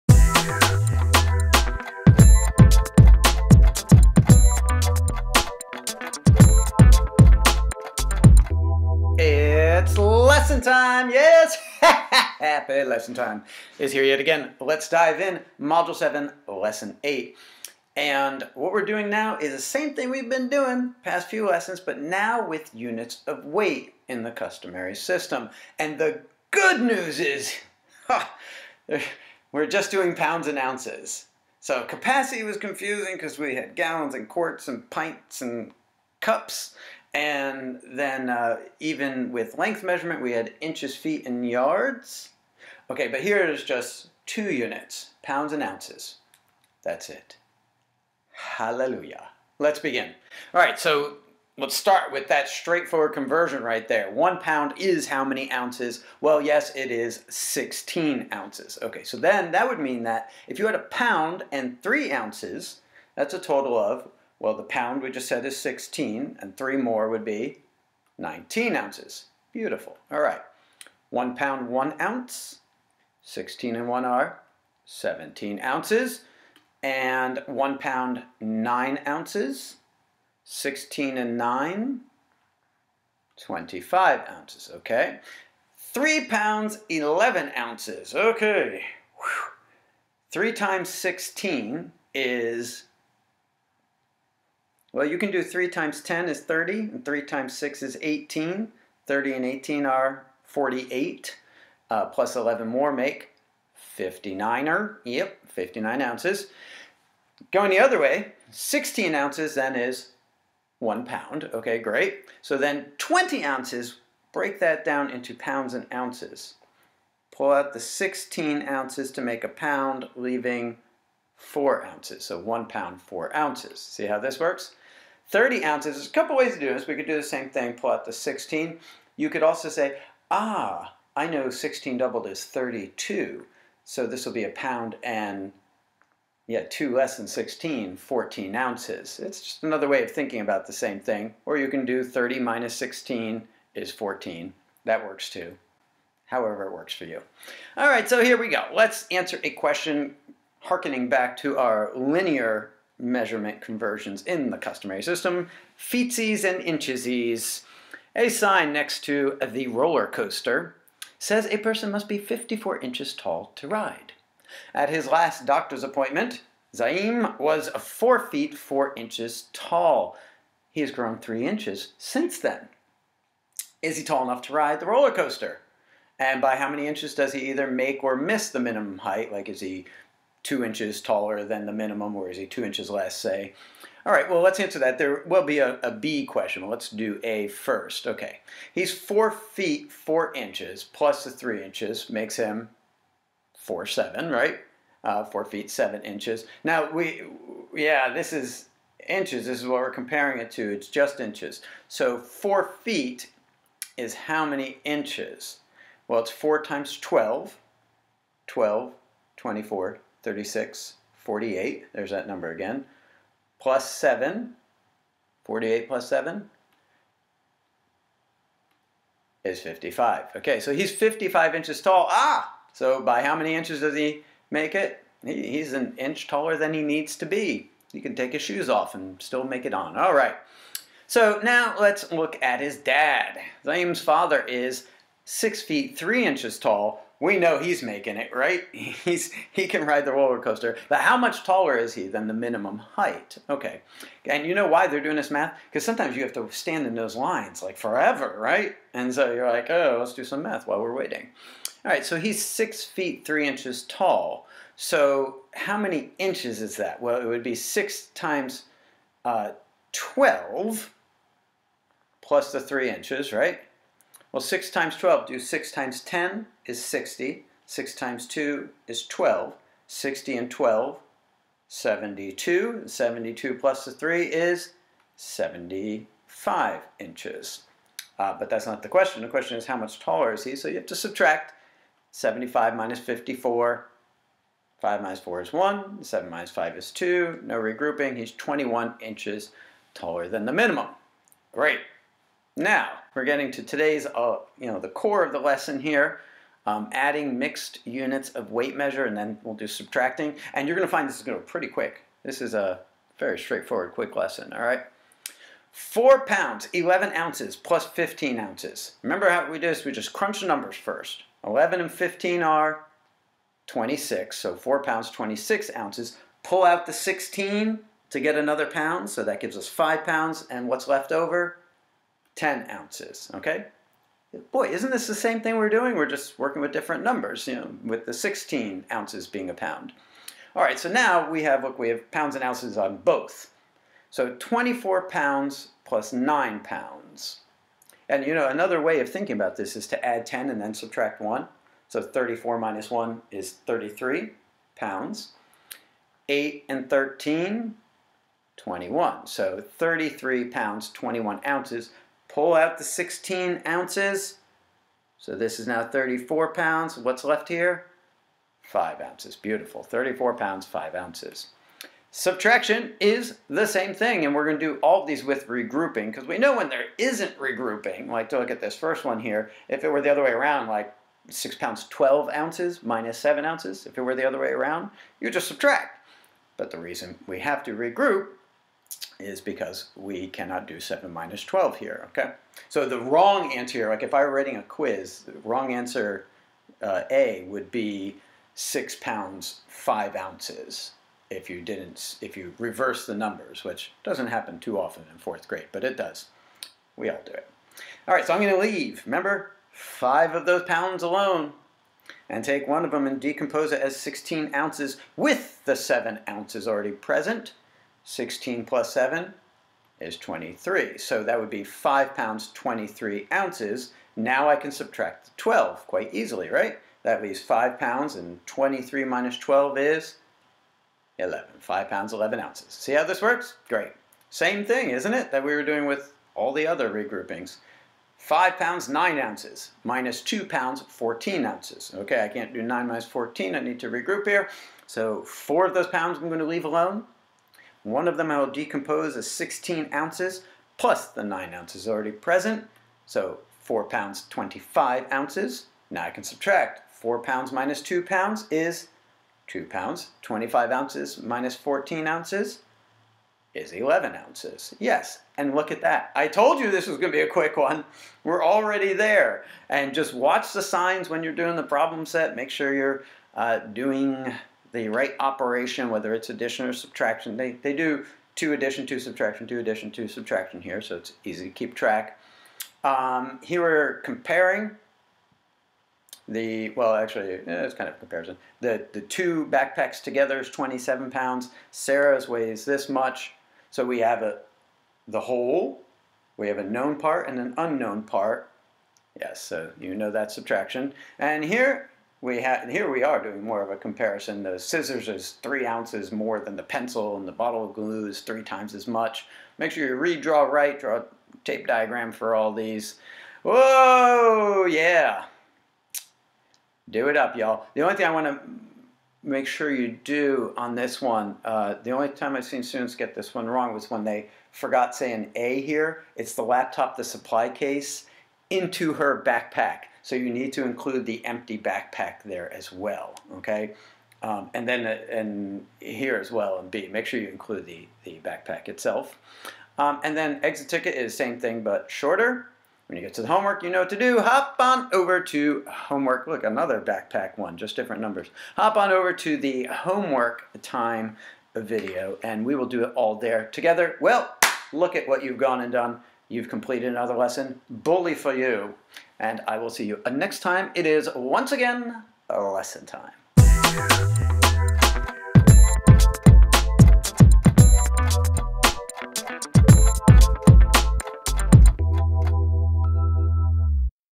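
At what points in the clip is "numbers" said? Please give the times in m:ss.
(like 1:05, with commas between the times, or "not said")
3:32, 5:10, 5:27, 6:33, 8:58.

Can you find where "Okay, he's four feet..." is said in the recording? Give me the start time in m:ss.
3:08.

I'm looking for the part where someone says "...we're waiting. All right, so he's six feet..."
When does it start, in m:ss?
4:10.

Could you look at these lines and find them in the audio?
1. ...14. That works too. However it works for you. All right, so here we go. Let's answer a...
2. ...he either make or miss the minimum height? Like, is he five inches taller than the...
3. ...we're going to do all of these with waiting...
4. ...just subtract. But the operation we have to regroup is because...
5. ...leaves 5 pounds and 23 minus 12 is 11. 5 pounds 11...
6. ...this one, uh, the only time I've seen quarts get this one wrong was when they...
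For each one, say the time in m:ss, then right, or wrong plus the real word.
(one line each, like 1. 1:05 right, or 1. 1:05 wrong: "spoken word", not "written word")
1. 2:23 right
2. 2:57 wrong: "two", not "five"
3. 6:04 wrong: "regrouping", not "waiting"
4. 6:15 wrong: "reason", not "operation"
5. 6:57 right
6. 8:30 wrong: "students", not "quarts".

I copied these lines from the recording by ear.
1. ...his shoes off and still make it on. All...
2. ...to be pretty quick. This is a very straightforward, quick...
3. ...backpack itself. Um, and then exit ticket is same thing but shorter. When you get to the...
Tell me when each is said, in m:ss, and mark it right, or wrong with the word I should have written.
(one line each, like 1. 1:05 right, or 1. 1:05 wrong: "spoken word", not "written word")
1. 3:48 right
2. 5:01 right
3. 8:48 right.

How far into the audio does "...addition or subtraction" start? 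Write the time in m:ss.
7:46.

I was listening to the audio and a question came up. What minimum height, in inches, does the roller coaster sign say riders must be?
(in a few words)
54 inches.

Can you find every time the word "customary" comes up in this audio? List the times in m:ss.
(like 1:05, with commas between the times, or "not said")
0:24, 2:34.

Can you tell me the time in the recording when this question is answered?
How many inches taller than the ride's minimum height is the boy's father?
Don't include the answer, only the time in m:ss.
4:48.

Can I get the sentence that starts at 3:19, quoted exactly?
This is what we're comparing it to.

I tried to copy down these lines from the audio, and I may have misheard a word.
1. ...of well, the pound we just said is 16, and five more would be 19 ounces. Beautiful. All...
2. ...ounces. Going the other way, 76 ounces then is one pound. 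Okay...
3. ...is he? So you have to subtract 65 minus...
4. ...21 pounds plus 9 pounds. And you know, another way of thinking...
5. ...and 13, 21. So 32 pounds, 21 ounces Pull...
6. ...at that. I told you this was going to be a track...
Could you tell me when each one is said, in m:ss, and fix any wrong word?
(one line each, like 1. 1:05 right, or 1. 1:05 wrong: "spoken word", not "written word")
1. 1:03 wrong: "three", not "five"
2. 1:46 wrong: "16", not "76"
3. 4:40 wrong: "75", not "65"
4. 5:34 wrong: "24", not "21"
5. 5:46 wrong: "33", not "32"
6. 7:35 wrong: "quick", not "track".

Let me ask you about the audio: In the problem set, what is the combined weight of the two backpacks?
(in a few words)
27 pounds.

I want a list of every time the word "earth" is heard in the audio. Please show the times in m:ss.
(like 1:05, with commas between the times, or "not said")
not said.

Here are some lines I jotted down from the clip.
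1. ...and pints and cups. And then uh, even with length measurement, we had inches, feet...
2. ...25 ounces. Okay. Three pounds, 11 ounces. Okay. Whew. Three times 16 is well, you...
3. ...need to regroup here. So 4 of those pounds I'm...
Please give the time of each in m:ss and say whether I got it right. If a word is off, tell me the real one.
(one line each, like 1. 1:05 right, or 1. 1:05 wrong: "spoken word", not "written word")
1. 0:34 right
2. 1:23 right
3. 7:13 right.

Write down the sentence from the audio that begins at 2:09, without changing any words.
You could also say, ah, I know 16 doubled is 32.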